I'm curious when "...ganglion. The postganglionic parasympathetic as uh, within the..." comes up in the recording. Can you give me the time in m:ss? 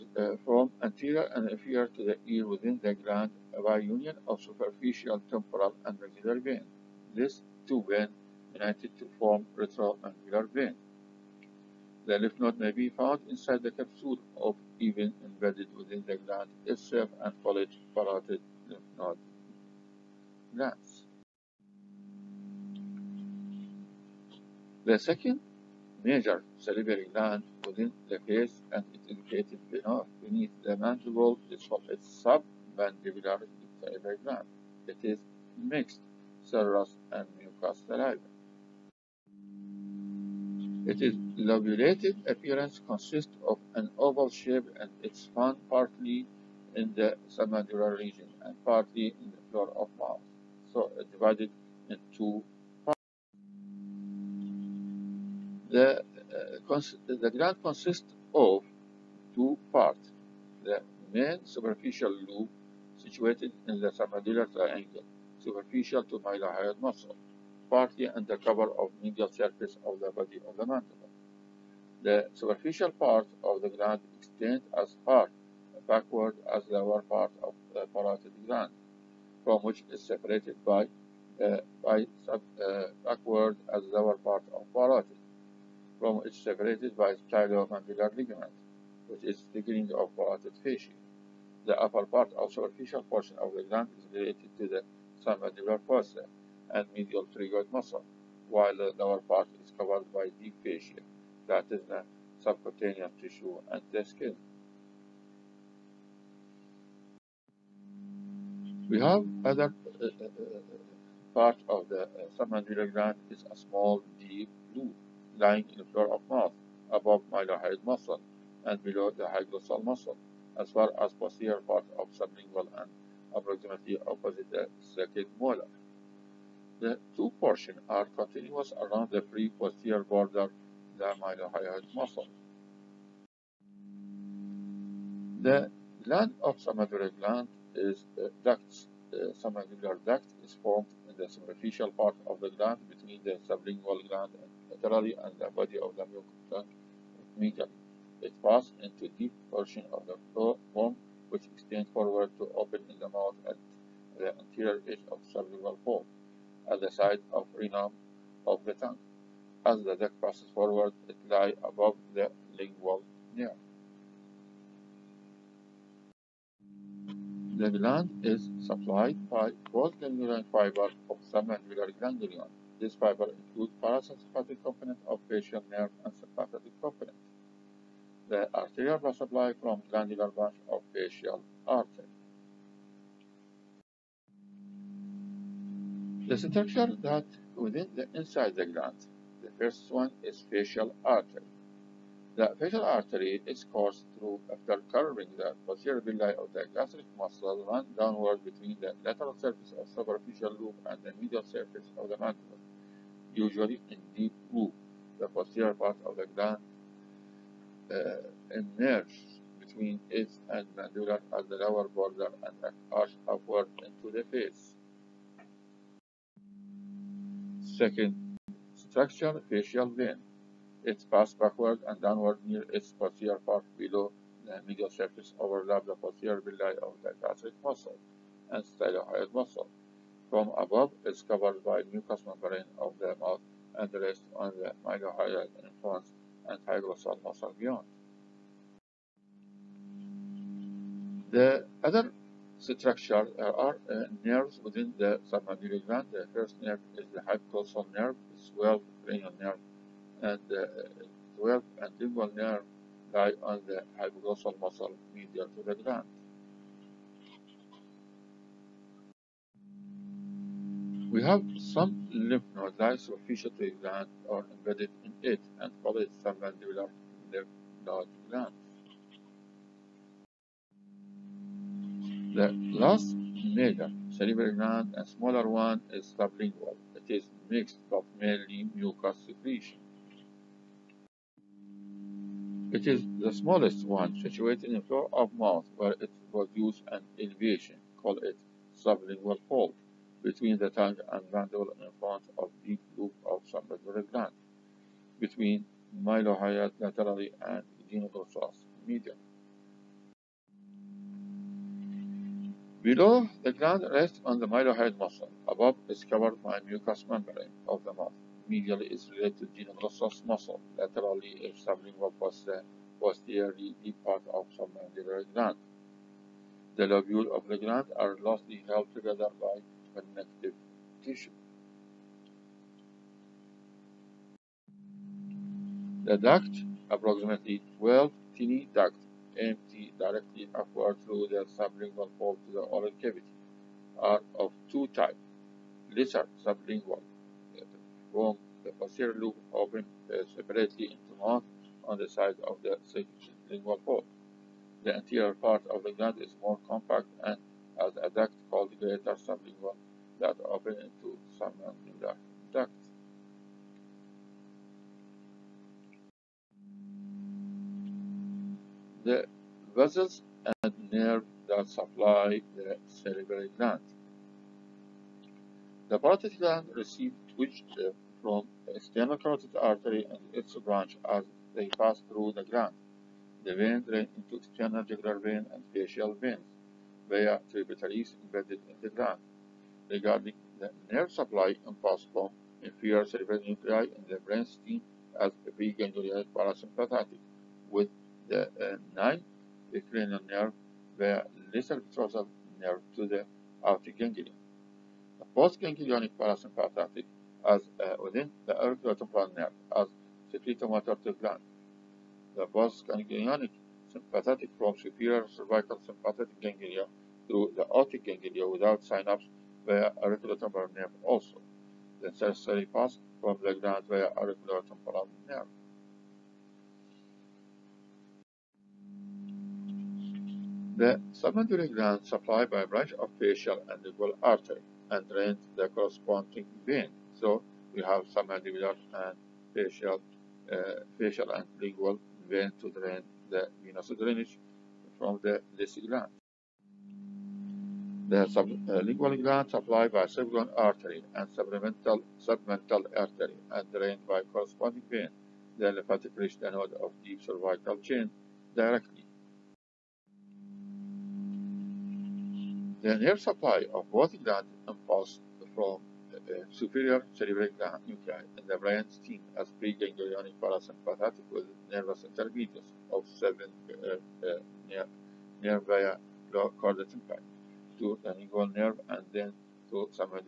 6:33.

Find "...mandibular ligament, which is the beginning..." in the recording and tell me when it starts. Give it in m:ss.
1:27.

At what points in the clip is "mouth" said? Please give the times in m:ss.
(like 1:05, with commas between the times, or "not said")
0:49, 1:56, 2:33, 3:53, 4:45, 5:07, 5:41.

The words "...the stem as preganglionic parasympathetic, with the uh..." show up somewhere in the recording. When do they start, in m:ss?
6:24.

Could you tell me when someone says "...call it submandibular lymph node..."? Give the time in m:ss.
4:25.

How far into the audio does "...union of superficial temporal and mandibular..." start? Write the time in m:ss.
0:03.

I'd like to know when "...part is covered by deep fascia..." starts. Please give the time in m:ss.
1:39.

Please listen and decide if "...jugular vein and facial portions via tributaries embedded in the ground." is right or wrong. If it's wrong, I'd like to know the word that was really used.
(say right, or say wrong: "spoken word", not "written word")
wrong: "veins", not "portions".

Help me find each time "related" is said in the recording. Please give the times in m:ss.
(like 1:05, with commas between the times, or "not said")
1:34, 5:09.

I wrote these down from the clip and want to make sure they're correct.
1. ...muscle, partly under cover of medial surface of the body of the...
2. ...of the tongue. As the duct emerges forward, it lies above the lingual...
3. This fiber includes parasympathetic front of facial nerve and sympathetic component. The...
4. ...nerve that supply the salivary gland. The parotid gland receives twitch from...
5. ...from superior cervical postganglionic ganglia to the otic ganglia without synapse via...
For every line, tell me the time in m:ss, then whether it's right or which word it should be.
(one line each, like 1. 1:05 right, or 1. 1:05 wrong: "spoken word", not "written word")
1. 1:06 right
2. 2:38 wrong: "passes", not "emerges"
3. 2:52 wrong: "component", not "front"
4. 6:00 right
5. 6:44 wrong: "sympathetic", not "postganglionic".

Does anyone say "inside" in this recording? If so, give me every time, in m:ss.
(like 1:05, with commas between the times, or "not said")
0:13, 3:08.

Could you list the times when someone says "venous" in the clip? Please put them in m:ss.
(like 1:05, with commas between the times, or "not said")
7:13.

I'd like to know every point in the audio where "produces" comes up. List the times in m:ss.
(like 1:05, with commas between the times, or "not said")
4:46.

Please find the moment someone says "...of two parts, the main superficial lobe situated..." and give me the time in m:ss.
0:58.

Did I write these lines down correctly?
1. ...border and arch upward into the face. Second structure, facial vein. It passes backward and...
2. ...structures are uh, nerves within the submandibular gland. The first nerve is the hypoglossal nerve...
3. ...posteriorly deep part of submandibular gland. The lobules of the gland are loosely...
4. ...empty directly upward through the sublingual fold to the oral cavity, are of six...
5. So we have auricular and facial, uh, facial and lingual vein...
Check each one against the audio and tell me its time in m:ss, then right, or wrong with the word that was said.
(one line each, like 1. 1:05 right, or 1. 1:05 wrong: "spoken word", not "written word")
1. 3:31 right
2. 4:02 right
3. 5:13 right
4. 5:29 wrong: "two", not "six"
5. 7:07 wrong: "submandibular", not "auricular".